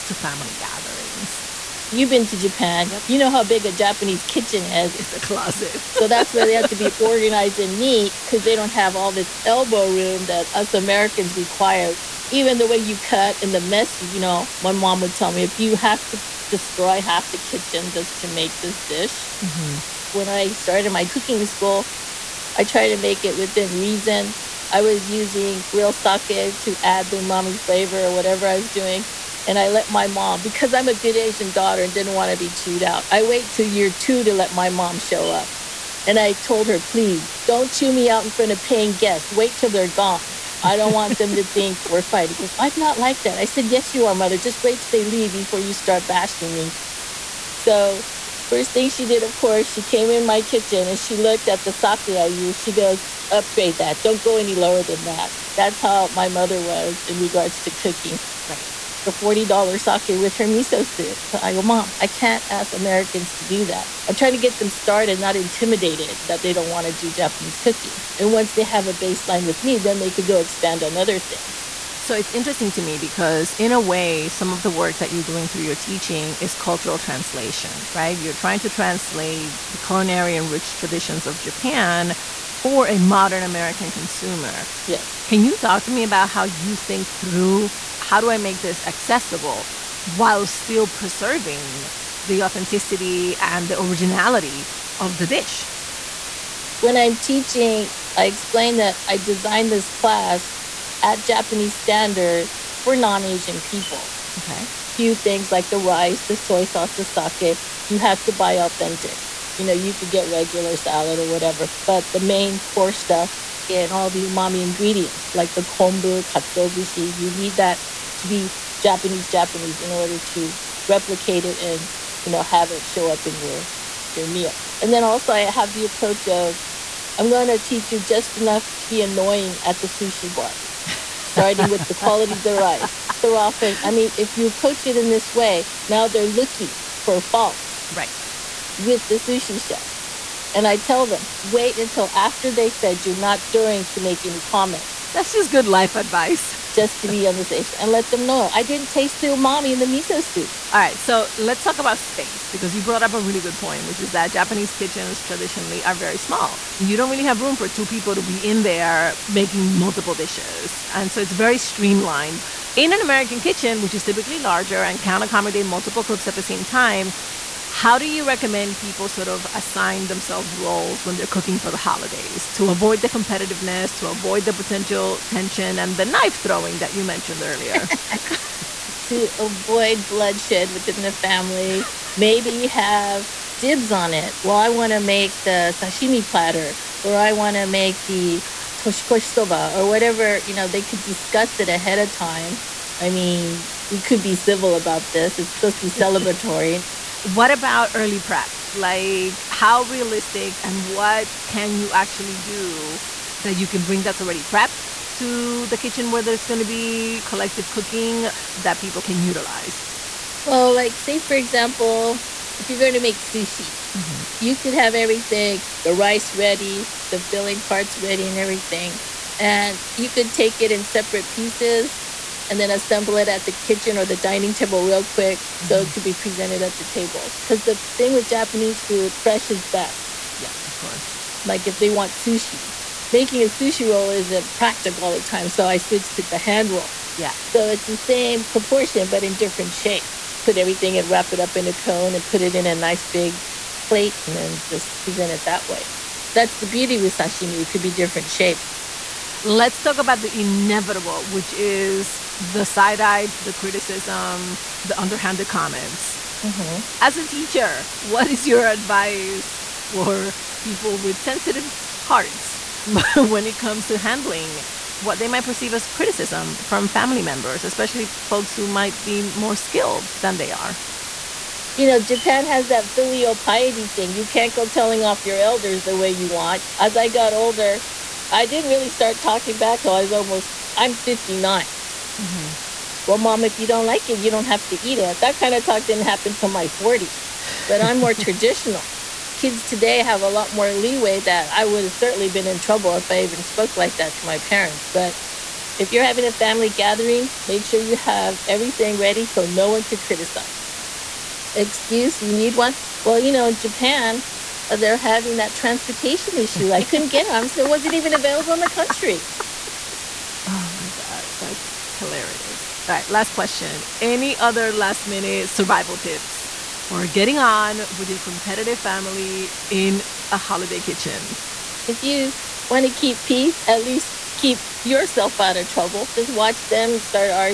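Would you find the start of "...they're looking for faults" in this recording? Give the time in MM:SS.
02:16.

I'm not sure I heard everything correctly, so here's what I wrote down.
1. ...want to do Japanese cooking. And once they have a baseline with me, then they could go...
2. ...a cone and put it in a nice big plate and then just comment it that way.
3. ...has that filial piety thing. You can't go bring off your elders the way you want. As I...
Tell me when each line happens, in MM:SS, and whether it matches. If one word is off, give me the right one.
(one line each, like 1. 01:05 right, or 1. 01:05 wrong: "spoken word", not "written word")
1. 01:06 right
2. 04:01 wrong: "present", not "comment"
3. 04:32 wrong: "telling", not "bring".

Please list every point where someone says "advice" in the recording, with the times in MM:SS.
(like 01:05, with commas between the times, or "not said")
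02:25, 04:18.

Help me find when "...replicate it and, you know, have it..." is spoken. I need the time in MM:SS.
02:00.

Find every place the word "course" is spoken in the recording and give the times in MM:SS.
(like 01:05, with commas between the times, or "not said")
00:49, 03:50.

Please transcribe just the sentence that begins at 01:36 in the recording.
When I'm teaching, I explain that I designed this class at Japanese standard for non Asian people.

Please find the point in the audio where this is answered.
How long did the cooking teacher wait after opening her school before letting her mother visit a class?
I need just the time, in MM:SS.
00:33.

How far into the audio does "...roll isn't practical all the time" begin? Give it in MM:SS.
03:53.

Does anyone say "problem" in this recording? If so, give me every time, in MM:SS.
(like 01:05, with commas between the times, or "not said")
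not said.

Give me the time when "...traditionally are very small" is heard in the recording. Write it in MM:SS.
02:35.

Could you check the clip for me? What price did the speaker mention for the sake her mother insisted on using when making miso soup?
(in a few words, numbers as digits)
$40.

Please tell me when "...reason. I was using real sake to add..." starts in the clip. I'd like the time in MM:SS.
00:23.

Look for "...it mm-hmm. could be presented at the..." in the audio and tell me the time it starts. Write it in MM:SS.
03:45.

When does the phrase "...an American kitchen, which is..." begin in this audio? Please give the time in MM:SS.
02:42.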